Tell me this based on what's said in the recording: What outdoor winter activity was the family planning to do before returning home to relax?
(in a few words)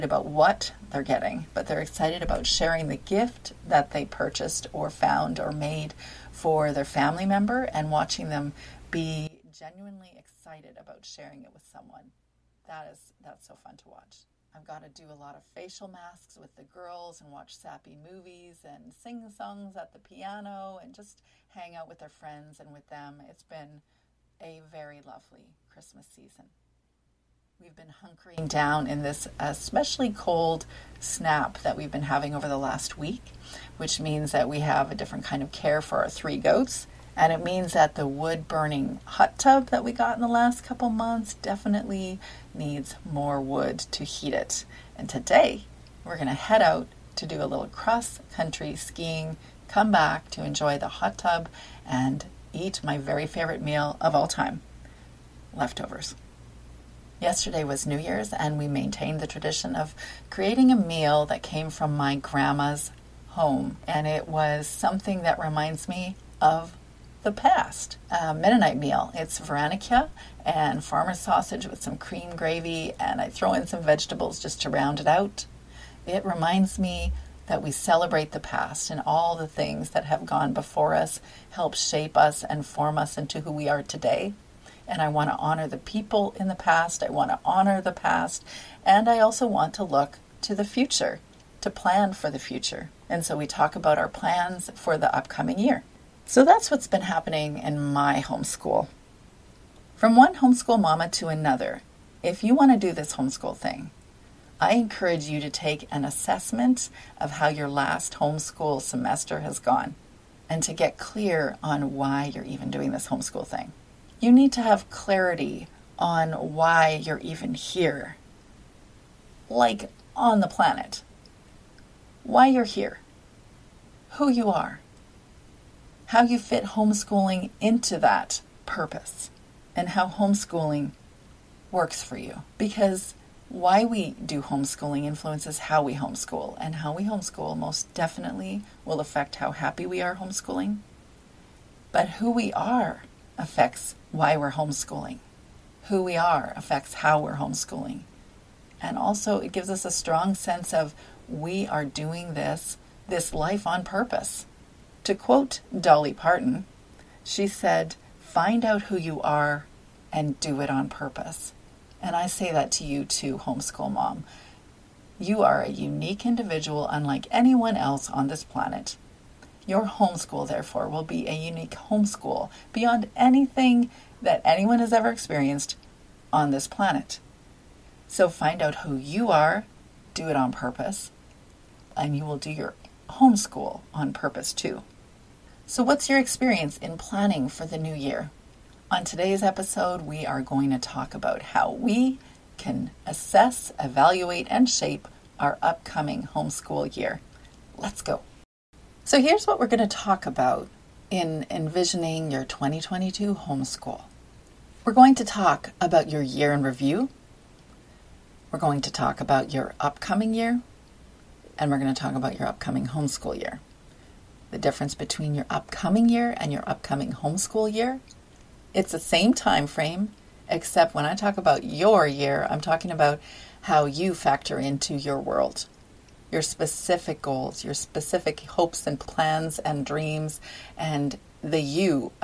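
Cross country skiing.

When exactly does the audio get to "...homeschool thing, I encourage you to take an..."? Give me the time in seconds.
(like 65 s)
103 s.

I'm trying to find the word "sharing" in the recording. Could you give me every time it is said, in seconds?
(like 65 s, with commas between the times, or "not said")
2 s, 11 s.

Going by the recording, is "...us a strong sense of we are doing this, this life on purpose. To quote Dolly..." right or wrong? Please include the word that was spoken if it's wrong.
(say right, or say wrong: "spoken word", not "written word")
right.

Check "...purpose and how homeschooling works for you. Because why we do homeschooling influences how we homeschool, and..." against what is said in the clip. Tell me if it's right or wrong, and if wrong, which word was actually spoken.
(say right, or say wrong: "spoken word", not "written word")
right.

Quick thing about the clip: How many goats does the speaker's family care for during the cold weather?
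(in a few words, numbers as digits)
3.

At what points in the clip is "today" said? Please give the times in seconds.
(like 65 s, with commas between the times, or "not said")
45 s, 83 s, 189 s.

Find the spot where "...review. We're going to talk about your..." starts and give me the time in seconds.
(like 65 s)
206 s.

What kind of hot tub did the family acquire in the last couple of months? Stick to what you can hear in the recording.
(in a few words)
Wood burning.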